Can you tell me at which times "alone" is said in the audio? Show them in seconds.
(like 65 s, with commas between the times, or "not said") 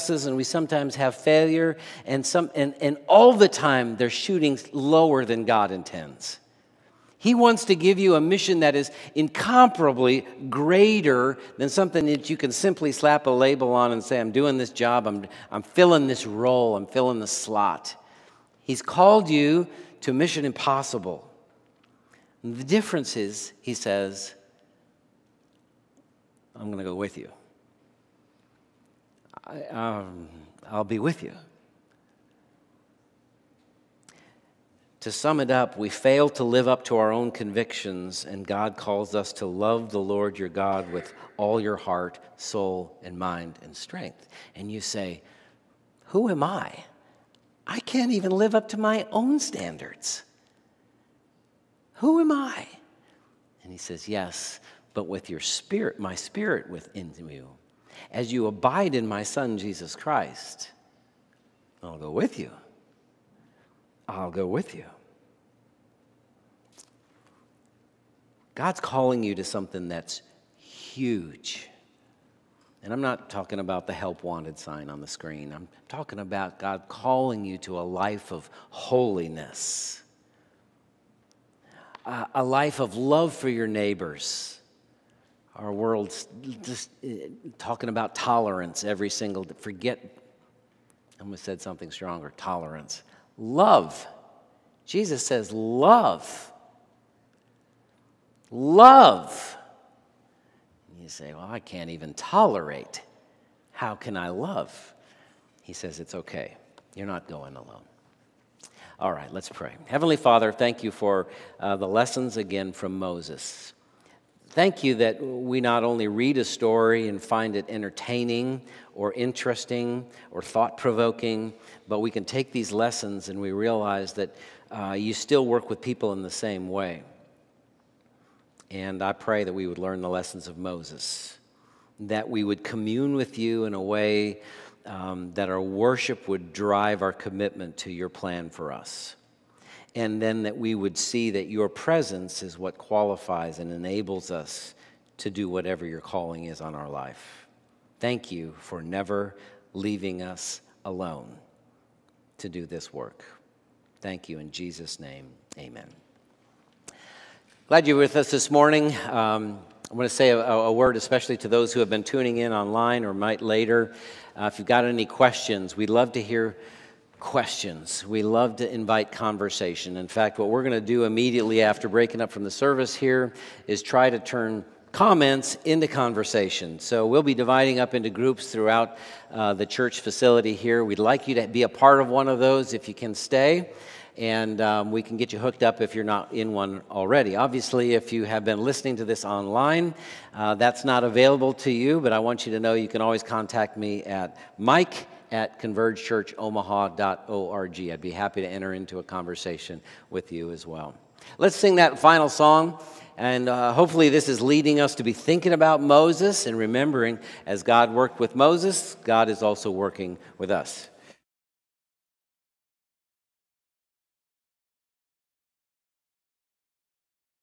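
107 s, 150 s.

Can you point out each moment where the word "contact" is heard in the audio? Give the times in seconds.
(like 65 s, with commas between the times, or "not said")
193 s.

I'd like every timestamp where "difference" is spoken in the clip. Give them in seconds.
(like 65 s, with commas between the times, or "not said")
22 s.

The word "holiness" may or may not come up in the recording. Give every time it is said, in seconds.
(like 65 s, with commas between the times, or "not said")
78 s.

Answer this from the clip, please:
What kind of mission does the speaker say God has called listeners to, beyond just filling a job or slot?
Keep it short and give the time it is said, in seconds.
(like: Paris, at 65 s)
Mission impossible, at 20 s.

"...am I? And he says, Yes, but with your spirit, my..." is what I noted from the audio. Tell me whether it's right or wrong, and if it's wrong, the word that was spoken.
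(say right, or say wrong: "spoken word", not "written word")
right.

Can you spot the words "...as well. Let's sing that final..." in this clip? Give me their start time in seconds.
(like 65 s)
200 s.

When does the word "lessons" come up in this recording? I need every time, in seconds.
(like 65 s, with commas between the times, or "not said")
111 s, 122 s, 130 s.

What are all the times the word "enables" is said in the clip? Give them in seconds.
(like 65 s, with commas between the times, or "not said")
143 s.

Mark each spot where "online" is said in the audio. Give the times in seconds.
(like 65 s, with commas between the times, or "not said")
162 s, 189 s.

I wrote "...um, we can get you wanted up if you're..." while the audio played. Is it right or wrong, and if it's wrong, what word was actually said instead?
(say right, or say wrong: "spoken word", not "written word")
wrong: "hooked", not "wanted".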